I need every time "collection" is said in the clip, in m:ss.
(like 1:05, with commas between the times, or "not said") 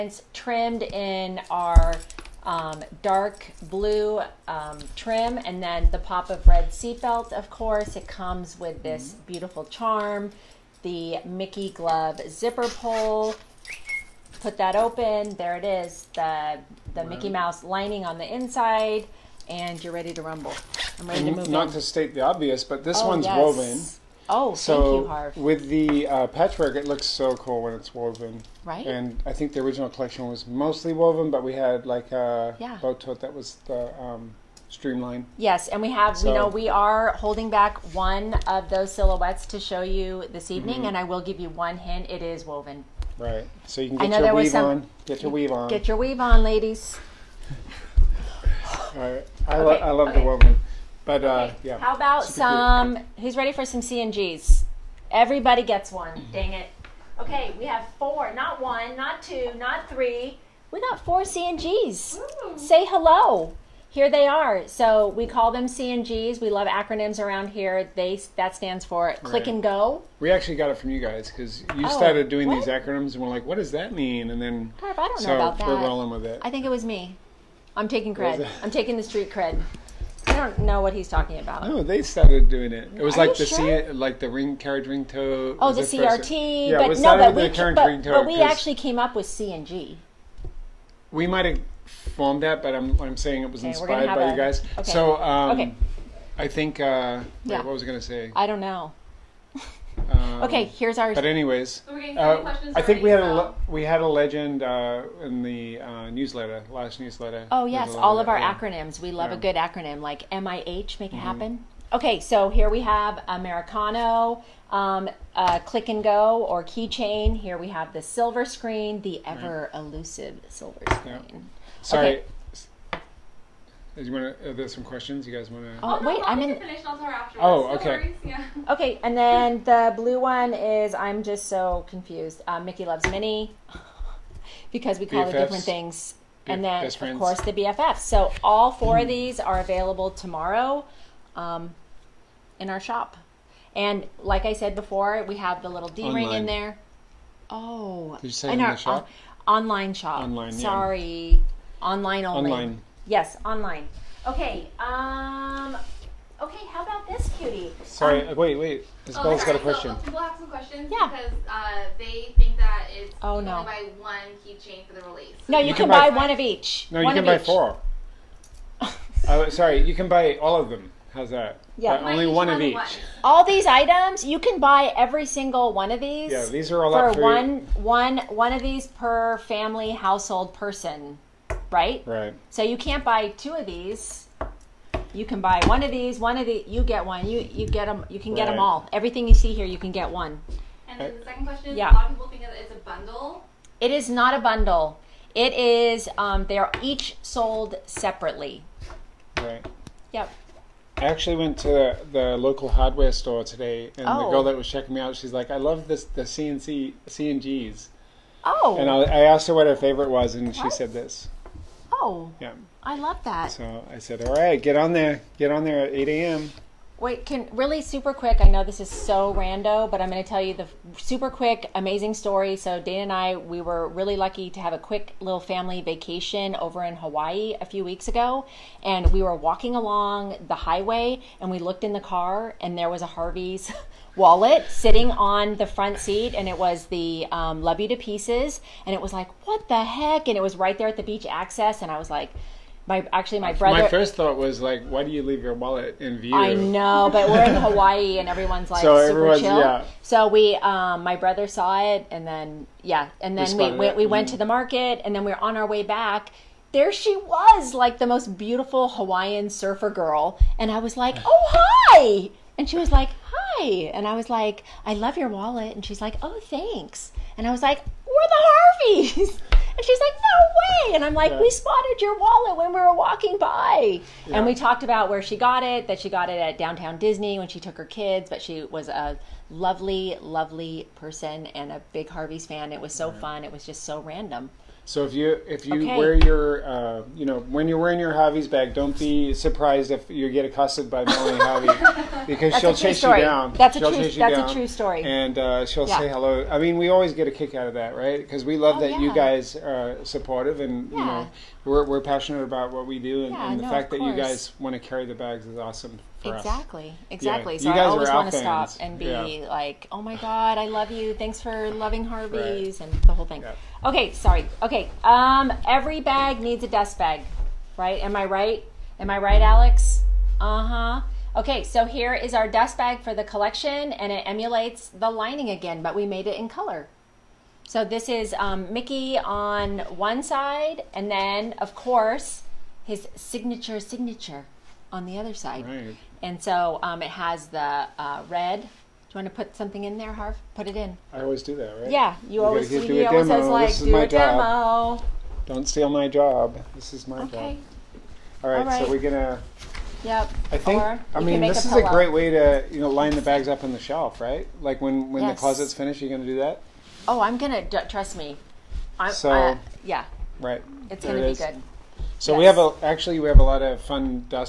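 0:29, 5:23.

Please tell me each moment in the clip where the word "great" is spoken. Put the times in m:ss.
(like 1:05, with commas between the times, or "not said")
5:51.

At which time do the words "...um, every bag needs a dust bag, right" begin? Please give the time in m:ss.
5:15.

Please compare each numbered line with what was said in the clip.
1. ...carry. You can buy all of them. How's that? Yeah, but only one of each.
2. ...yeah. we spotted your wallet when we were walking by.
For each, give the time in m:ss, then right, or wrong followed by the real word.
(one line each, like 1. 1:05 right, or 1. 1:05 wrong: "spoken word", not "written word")
1. 2:49 wrong: "sorry", not "carry"
2. 4:31 right.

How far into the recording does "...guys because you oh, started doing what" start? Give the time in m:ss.
1:11.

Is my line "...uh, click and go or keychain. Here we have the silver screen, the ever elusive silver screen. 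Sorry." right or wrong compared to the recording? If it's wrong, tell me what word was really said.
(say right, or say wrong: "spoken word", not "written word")
right.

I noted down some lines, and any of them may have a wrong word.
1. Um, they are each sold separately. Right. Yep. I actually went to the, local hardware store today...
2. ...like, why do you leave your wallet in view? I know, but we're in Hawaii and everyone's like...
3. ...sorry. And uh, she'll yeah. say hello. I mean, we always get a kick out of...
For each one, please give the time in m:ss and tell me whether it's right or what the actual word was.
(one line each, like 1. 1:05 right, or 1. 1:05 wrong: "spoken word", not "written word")
1. 3:16 right
2. 4:04 right
3. 4:54 wrong: "story", not "sorry".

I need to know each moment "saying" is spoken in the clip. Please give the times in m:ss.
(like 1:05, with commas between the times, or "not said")
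1:33.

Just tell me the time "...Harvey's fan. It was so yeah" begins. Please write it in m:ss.
4:42.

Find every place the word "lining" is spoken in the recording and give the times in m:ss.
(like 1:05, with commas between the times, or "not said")
0:17, 5:25.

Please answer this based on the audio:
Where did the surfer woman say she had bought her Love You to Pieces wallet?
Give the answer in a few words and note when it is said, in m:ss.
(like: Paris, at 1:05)
Downtown Disney, at 4:36.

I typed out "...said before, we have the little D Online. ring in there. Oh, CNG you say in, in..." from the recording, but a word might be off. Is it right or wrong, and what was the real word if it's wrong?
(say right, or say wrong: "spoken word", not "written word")
wrong: "Did", not "CNG".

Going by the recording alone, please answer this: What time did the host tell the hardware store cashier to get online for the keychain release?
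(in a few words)
8 a.m.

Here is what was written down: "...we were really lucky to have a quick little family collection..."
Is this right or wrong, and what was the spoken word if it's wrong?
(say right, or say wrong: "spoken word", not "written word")
wrong: "vacation", not "collection".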